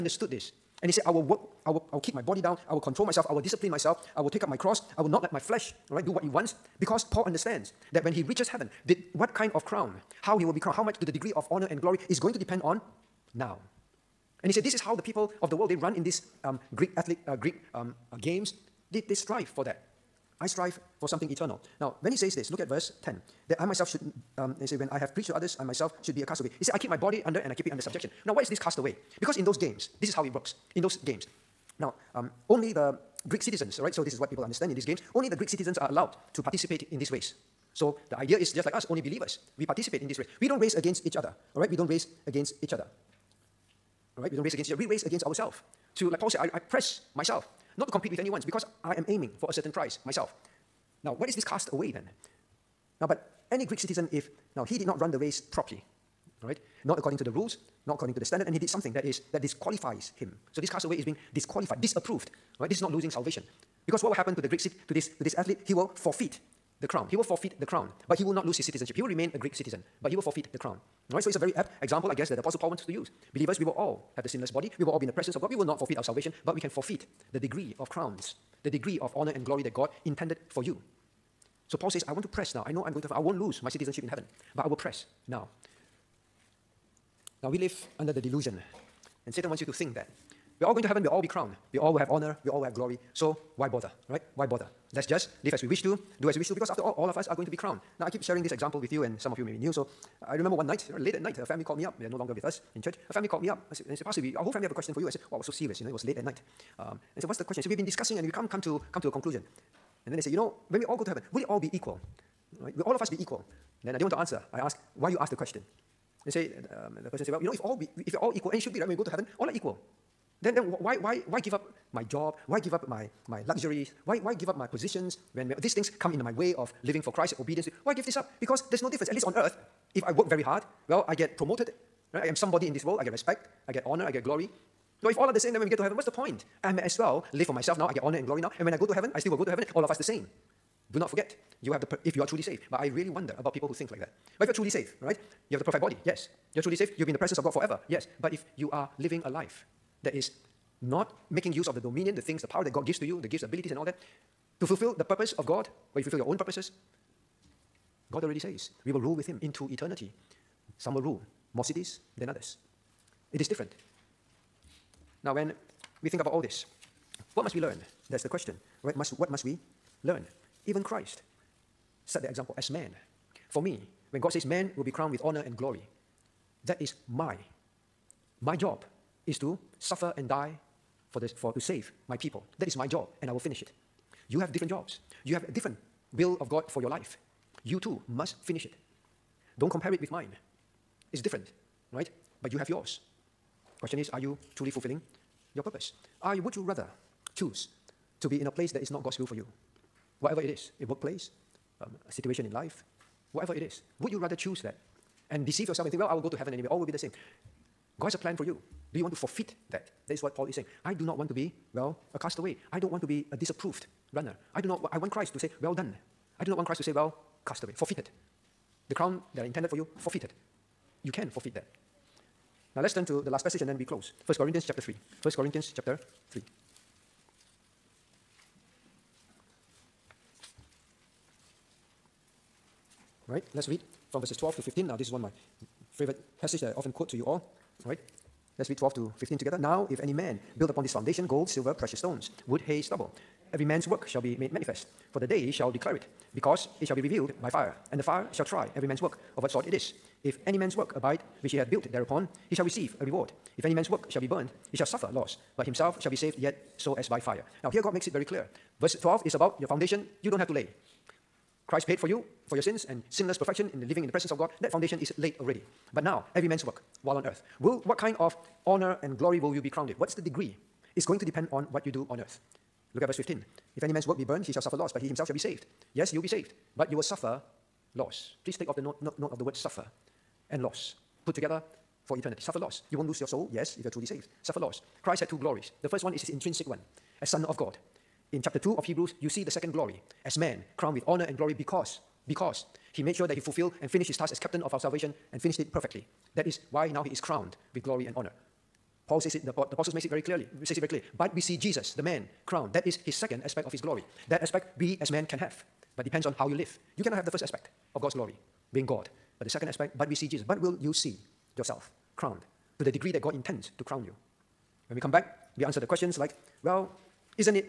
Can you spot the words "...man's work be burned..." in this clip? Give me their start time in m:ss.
4:33.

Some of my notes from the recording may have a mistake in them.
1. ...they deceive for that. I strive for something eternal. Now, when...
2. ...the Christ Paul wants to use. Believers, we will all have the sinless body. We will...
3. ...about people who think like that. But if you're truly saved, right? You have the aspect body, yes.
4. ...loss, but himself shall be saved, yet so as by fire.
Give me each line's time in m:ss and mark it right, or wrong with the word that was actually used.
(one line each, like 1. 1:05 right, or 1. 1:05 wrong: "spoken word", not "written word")
1. 0:19 wrong: "strive", not "deceive"
2. 1:12 wrong: "Apostle", not "Christ"
3. 2:23 wrong: "perfect", not "aspect"
4. 4:15 right.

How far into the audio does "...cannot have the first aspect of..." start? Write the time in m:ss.
5:07.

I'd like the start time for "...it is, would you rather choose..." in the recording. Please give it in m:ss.
3:23.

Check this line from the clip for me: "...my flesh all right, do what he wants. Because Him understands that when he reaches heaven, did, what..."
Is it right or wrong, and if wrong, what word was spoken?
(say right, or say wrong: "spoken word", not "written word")
wrong: "Paul", not "Him".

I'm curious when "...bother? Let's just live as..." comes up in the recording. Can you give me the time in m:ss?
1:34.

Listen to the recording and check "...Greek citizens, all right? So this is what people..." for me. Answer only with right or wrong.
right.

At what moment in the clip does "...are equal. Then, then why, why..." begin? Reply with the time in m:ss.
1:59.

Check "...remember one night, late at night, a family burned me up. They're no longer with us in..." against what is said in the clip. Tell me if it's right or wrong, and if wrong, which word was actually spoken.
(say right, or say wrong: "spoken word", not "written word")
wrong: "called", not "burned".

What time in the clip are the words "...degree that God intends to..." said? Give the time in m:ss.
5:12.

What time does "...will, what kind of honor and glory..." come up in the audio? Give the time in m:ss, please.
4:27.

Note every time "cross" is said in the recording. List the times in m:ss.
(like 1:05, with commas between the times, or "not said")
0:04.